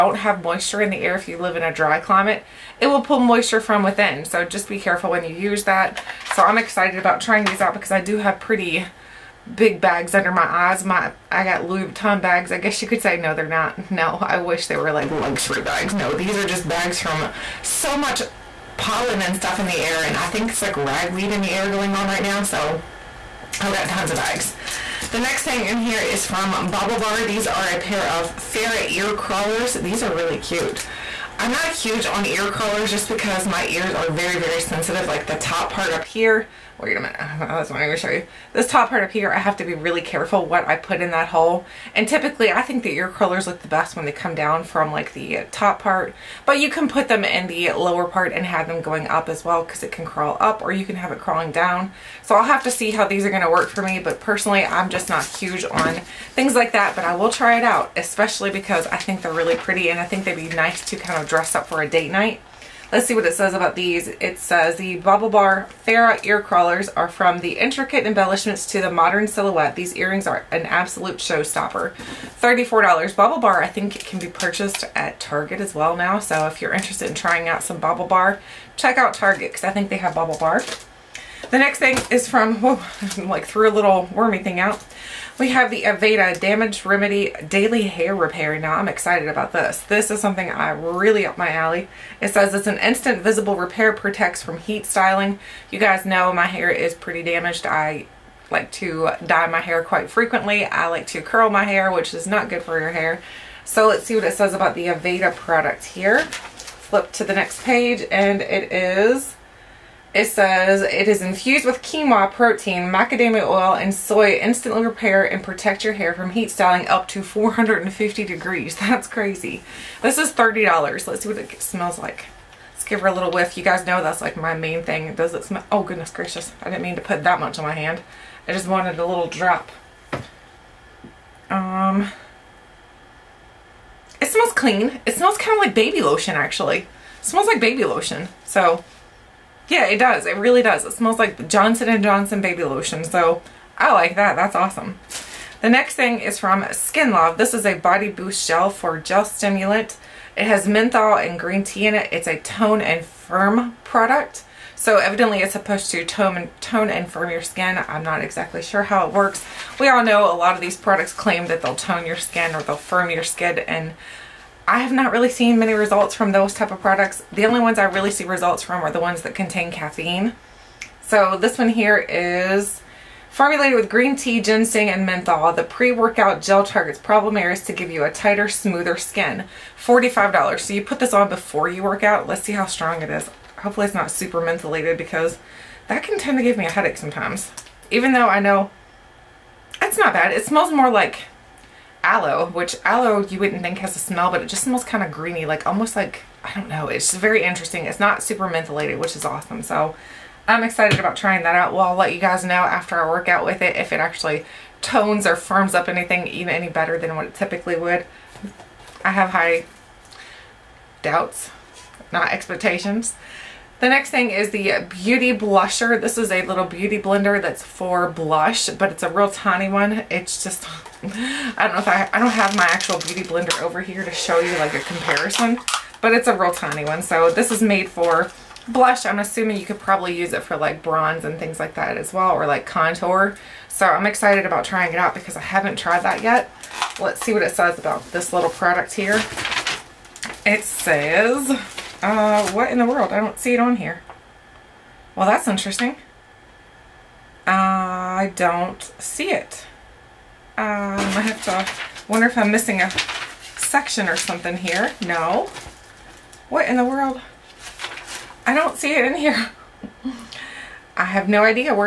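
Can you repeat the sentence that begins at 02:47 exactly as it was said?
The only ones I really see results from are the ones that contain caffeine.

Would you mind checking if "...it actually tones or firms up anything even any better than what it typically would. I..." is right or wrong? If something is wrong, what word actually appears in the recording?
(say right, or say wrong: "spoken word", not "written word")
right.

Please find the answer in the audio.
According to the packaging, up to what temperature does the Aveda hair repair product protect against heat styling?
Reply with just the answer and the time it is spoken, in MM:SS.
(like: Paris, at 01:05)
450 degrees, at 01:57.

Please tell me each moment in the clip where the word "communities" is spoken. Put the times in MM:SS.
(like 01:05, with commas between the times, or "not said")
not said.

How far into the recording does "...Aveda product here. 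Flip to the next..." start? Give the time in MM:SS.
01:44.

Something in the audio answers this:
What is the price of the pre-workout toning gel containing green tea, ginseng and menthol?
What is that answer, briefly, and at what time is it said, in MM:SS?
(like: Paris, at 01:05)
$45, at 02:59.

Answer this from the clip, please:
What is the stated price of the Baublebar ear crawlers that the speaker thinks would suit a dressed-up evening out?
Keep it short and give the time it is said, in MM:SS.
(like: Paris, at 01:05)
$34, at 01:12.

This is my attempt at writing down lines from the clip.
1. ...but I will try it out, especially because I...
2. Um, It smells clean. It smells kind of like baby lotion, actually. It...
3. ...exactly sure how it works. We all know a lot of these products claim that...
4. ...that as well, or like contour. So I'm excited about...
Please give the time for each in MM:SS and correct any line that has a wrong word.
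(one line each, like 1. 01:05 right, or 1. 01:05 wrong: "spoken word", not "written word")
1. 00:56 right
2. 02:11 right
3. 02:38 right
4. 03:51 right.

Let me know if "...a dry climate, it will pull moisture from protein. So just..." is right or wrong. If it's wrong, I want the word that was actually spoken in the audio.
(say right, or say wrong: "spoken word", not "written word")
wrong: "within", not "protein".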